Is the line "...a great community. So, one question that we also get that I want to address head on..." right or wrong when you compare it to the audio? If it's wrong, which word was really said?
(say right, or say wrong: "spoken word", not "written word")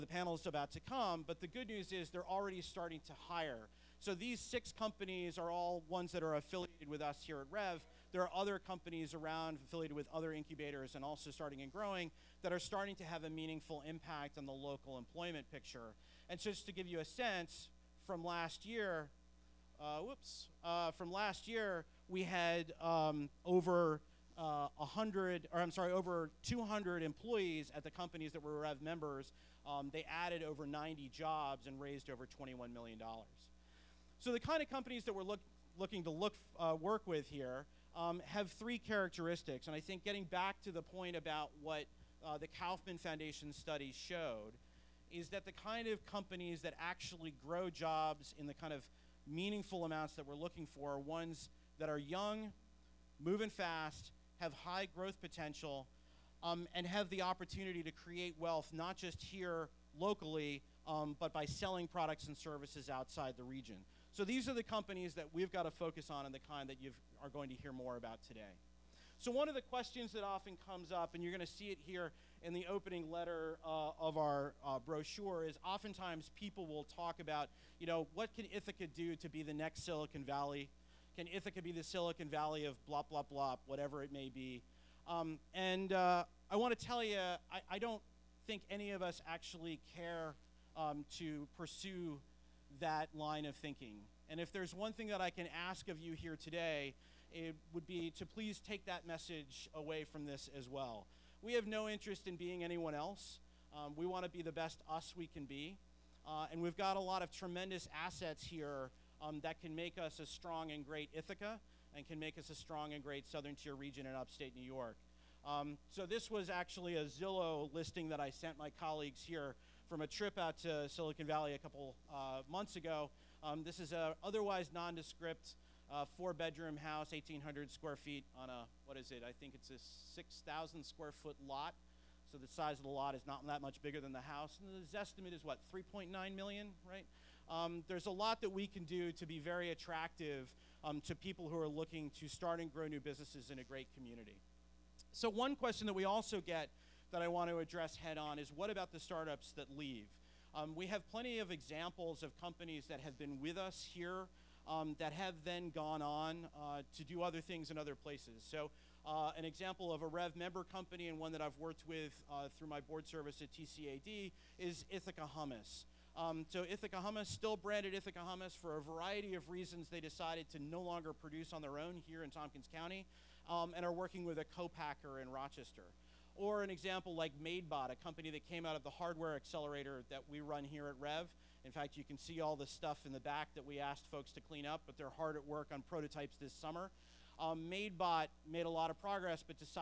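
right.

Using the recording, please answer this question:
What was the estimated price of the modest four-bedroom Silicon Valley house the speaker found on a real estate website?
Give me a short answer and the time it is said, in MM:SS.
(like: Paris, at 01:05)
3.9 million, at 02:15.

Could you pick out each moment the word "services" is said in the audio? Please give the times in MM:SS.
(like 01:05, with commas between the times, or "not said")
01:02, 02:43.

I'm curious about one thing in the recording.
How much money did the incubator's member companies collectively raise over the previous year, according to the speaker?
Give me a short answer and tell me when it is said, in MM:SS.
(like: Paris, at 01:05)
over $21 million, at 00:32.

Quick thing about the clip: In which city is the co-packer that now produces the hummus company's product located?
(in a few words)
Rochester.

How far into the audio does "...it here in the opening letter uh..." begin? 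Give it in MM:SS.
01:11.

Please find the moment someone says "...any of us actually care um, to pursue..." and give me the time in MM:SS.
01:28.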